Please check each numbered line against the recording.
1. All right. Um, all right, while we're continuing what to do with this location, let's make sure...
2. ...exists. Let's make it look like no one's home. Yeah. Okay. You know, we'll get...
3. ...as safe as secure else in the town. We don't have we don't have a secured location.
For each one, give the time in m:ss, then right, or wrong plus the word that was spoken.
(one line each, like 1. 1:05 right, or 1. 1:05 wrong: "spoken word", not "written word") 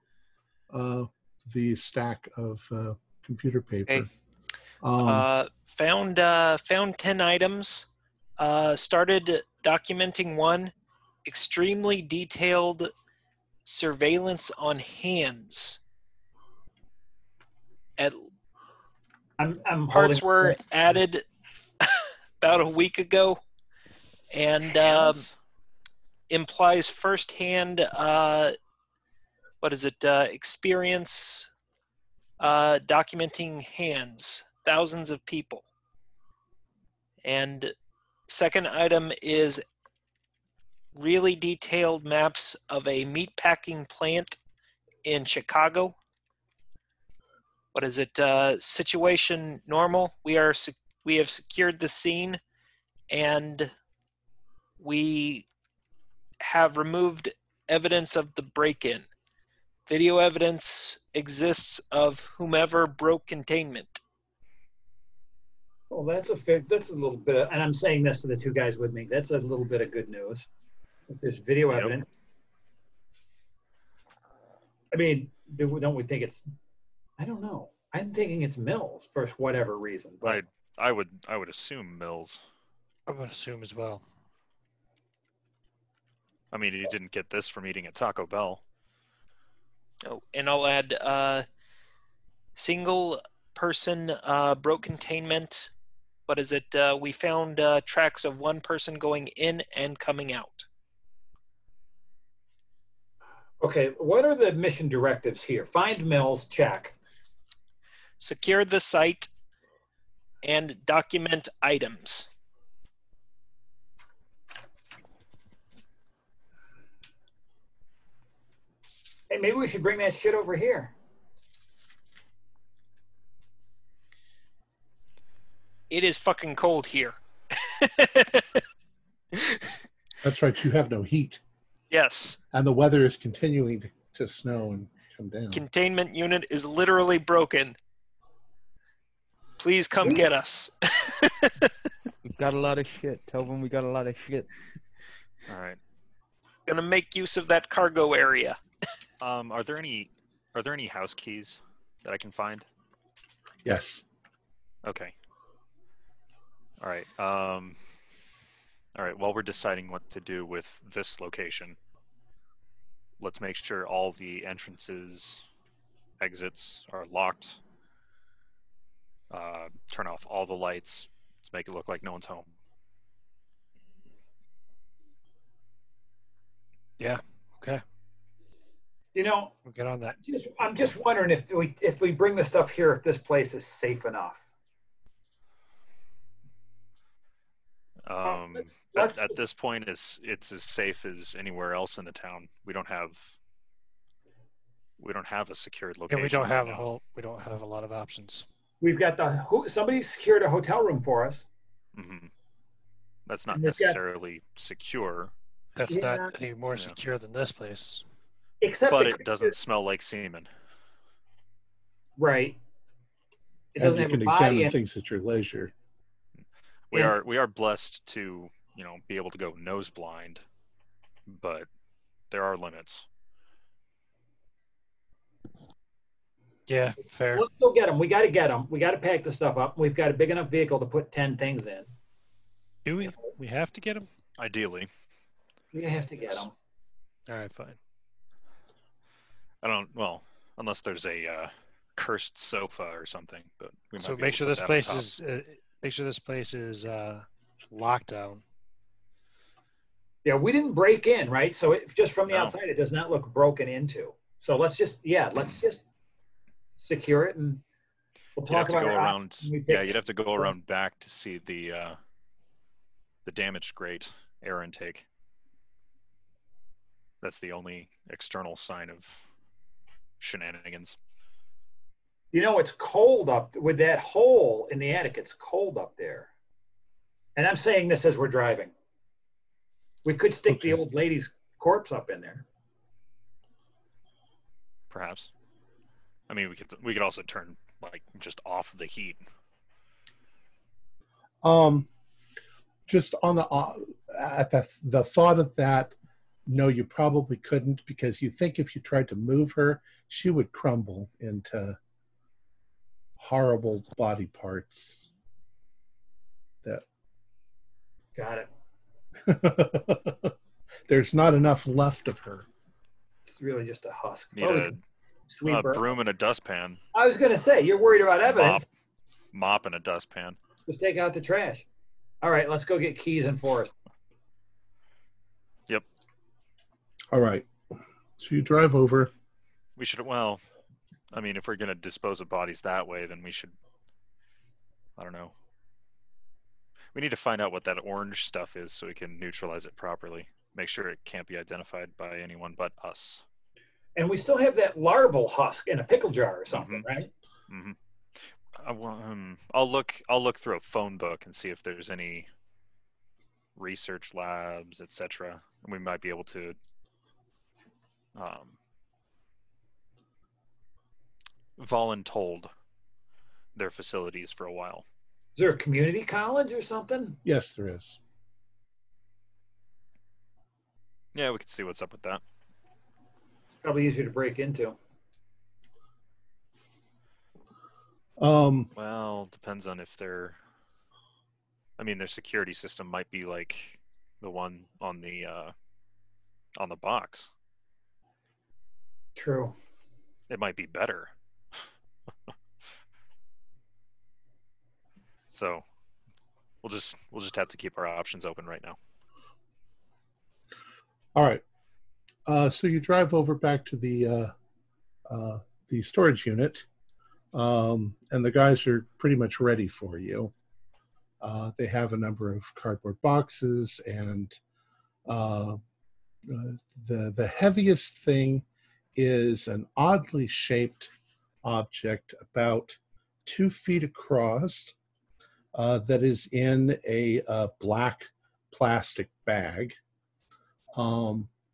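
1. 2:36 wrong: "deciding", not "continuing"
2. 2:50 wrong: "lights", not "exists"
3. 3:10 wrong: "anywhere", not "secure".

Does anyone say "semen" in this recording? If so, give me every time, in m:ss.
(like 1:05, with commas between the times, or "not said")
3:30.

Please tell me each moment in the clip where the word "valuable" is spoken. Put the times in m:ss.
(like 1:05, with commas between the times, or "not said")
not said.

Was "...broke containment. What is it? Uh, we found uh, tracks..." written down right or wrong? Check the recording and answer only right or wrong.
right.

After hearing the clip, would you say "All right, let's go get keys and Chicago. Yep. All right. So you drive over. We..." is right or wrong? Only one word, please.
wrong.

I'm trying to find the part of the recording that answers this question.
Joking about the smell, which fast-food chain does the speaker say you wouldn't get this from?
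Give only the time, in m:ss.
1:27.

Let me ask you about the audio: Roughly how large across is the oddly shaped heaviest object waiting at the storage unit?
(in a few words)
2 feet.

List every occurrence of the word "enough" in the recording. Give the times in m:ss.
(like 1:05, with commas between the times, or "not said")
3:04, 3:50, 5:11.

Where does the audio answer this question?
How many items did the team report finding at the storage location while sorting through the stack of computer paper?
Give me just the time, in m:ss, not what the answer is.
0:06.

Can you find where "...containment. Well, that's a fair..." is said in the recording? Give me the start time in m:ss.
1:03.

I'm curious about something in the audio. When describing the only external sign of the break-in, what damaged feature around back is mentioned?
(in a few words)
grate air intake.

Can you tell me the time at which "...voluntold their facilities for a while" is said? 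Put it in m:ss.
6:01.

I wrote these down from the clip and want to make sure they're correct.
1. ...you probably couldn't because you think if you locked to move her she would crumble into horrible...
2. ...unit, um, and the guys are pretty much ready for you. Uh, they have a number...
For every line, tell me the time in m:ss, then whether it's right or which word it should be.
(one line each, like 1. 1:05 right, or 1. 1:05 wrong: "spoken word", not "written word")
1. 4:56 wrong: "tried", not "locked"
2. 6:46 right.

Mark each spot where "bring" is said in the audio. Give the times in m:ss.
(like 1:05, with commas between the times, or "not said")
1:59, 3:02.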